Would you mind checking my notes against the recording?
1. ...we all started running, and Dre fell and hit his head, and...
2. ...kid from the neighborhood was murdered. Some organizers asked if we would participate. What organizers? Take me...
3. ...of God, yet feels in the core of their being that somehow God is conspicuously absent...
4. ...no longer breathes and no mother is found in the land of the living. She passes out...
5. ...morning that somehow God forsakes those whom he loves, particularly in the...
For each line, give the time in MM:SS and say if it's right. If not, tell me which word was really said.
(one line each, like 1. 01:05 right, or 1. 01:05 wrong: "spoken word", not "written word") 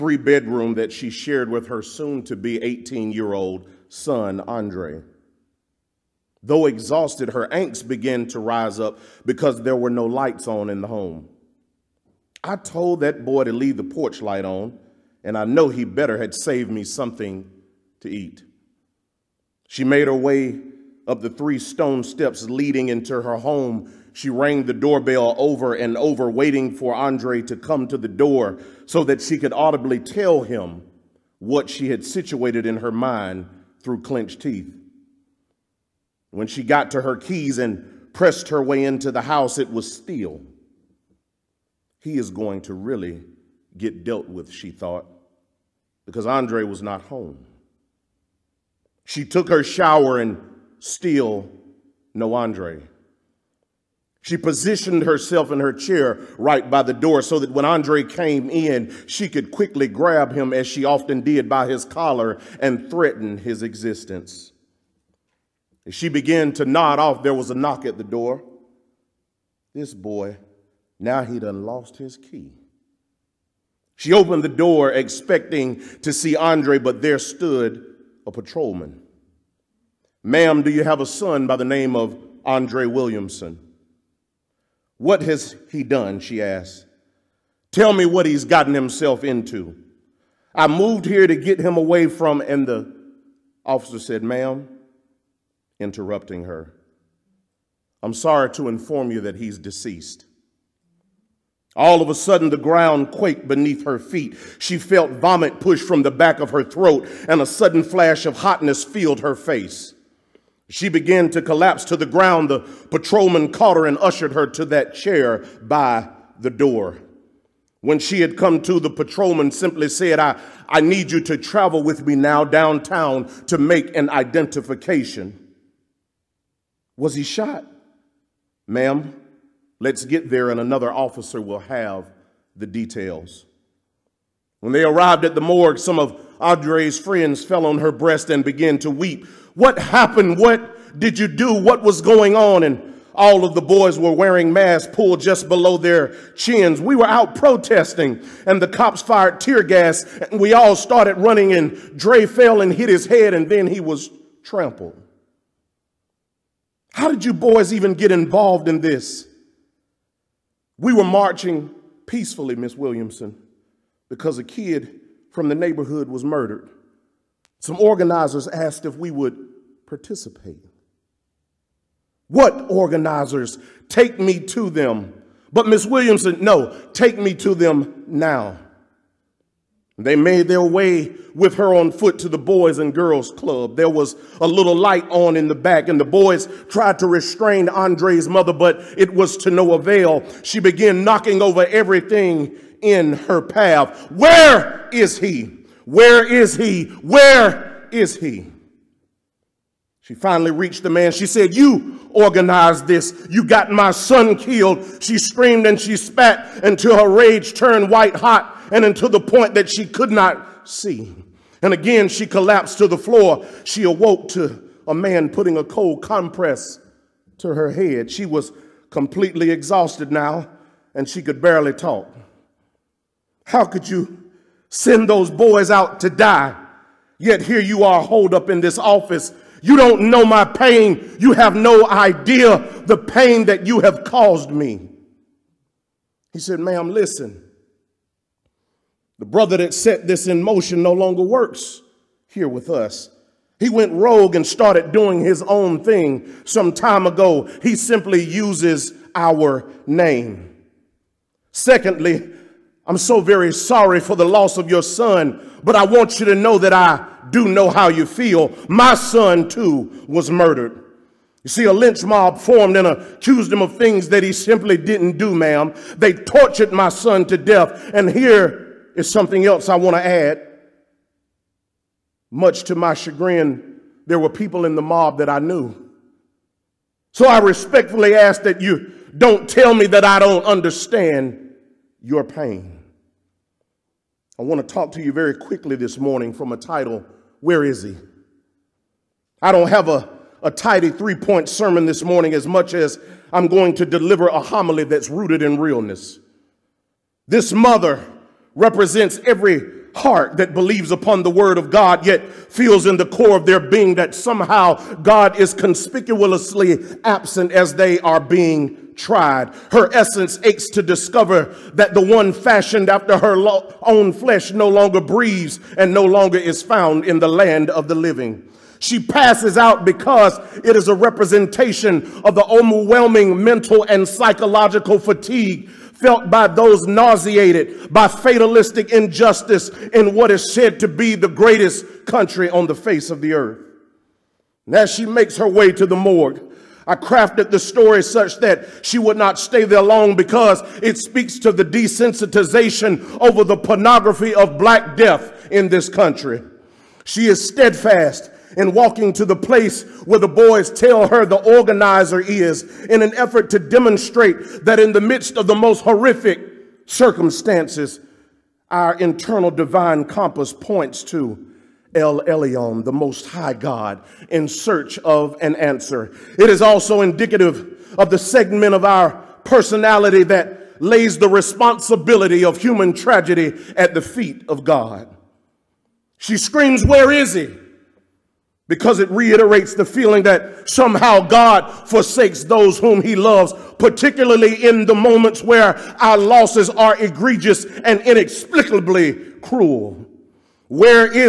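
1. 02:30 right
2. 02:44 right
3. 05:01 right
4. 05:14 wrong: "longer", not "mother"
5. 06:19 wrong: "feeling", not "morning".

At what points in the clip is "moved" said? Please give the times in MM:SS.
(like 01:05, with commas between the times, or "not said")
01:30.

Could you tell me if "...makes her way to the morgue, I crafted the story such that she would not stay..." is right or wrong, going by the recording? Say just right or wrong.
right.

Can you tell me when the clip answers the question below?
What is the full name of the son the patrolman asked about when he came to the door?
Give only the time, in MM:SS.
01:22.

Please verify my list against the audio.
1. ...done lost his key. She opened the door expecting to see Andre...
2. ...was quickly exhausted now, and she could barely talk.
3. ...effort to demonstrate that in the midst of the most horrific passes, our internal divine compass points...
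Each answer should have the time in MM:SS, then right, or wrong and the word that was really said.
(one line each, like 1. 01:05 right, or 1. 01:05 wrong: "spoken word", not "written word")
1. 01:11 right
2. 03:38 wrong: "completely", not "quickly"
3. 05:53 wrong: "circumstances", not "passes".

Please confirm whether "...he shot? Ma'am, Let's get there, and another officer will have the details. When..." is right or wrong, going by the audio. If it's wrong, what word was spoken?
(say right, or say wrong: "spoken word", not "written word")
right.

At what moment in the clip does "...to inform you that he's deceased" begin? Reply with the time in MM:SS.
01:38.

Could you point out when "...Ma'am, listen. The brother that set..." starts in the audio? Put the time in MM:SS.
03:56.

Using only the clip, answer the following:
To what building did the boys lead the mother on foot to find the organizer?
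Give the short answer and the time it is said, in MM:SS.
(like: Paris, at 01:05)
The boys and girls club, at 03:02.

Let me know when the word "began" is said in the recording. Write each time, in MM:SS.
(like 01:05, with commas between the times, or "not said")
00:07, 01:06, 01:50, 02:18, 03:10.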